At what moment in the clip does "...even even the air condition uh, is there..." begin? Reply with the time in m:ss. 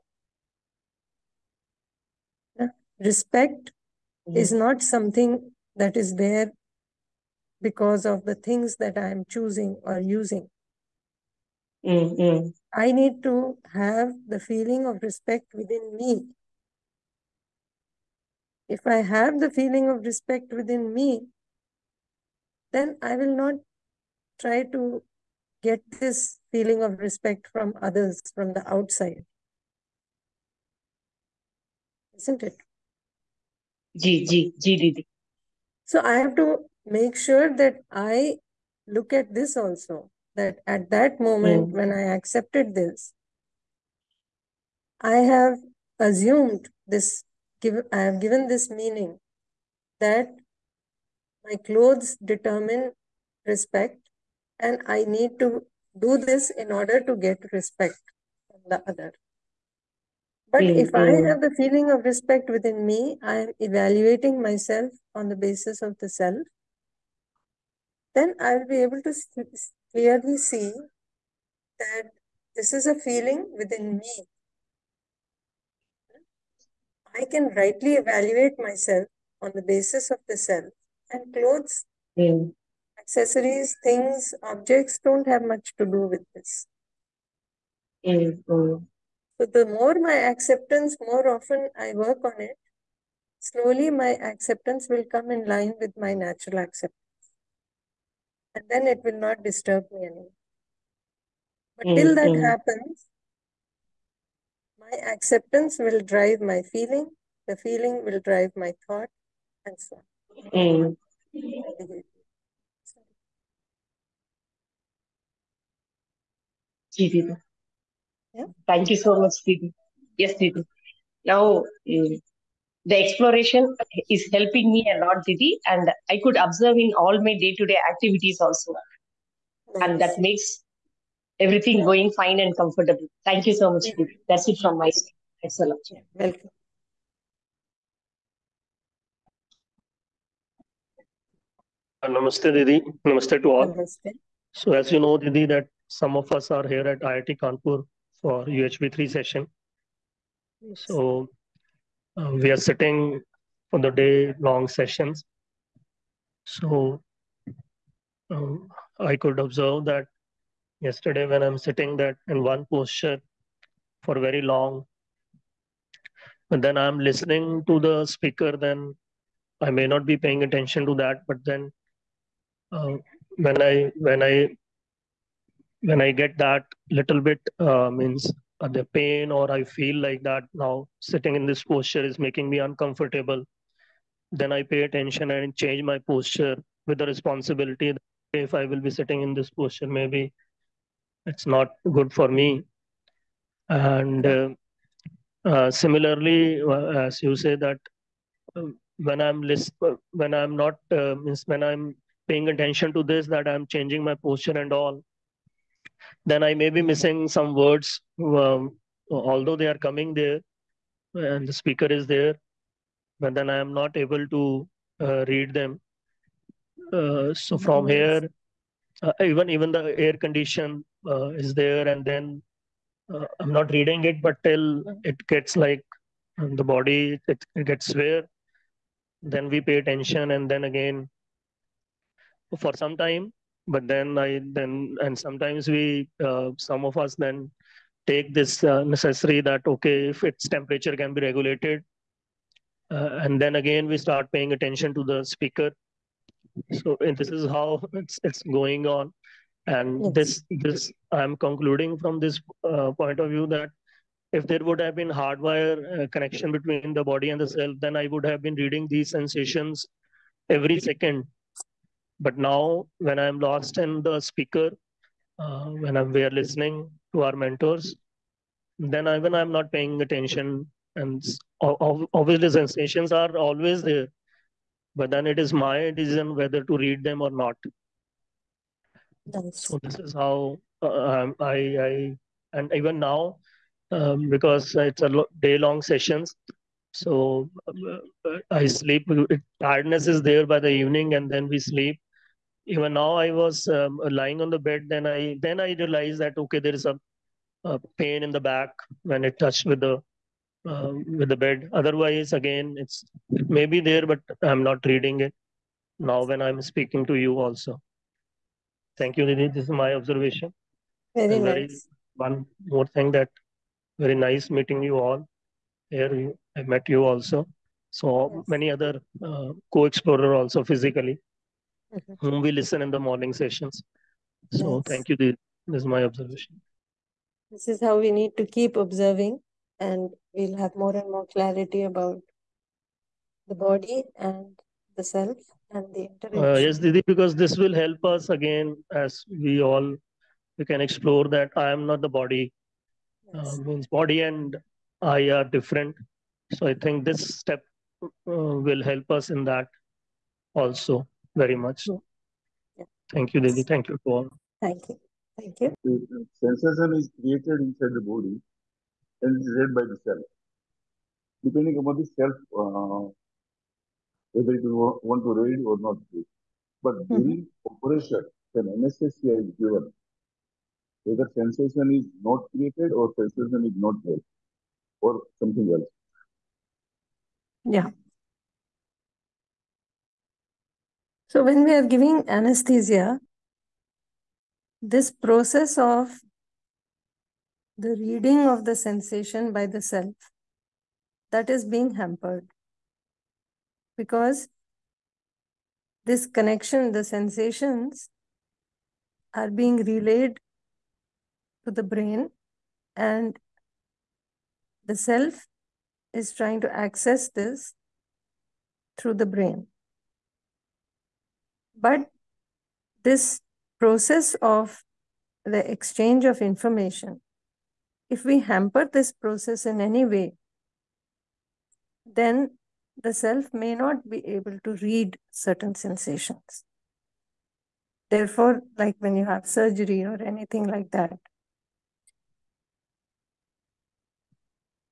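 3:39.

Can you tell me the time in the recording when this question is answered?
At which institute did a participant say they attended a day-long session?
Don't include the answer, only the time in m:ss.
2:27.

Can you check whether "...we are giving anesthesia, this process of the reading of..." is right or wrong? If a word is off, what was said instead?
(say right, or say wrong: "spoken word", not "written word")
right.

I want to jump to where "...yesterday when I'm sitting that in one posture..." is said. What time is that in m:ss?
2:40.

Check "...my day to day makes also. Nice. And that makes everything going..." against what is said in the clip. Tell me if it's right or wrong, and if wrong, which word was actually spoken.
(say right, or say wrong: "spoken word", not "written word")
wrong: "activities", not "makes".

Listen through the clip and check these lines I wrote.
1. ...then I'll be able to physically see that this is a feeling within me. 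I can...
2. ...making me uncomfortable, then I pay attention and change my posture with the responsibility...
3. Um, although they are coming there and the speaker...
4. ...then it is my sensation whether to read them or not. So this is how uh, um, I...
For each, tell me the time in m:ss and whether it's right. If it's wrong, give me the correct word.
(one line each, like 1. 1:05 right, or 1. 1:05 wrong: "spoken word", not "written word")
1. 1:08 wrong: "clearly", not "physically"
2. 3:02 right
3. 3:28 right
4. 4:35 wrong: "decision", not "sensation".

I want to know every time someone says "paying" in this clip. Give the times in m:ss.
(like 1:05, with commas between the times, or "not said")
2:50, 3:22, 4:04, 4:29.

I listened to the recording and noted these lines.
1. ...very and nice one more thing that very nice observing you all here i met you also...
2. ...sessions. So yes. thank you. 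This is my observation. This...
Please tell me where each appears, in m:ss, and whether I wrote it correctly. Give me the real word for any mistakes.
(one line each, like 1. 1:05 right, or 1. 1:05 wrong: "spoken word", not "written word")
1. 5:11 wrong: "meeting", not "observing"
2. 5:23 right.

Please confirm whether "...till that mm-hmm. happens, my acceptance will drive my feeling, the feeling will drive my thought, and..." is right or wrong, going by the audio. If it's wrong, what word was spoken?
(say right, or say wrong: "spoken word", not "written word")
right.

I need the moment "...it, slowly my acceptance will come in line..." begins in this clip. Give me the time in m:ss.
1:32.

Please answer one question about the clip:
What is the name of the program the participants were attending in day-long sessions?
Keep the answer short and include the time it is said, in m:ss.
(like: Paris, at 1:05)
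UHV3, at 2:28.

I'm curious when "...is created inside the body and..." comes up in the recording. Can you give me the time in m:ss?
5:56.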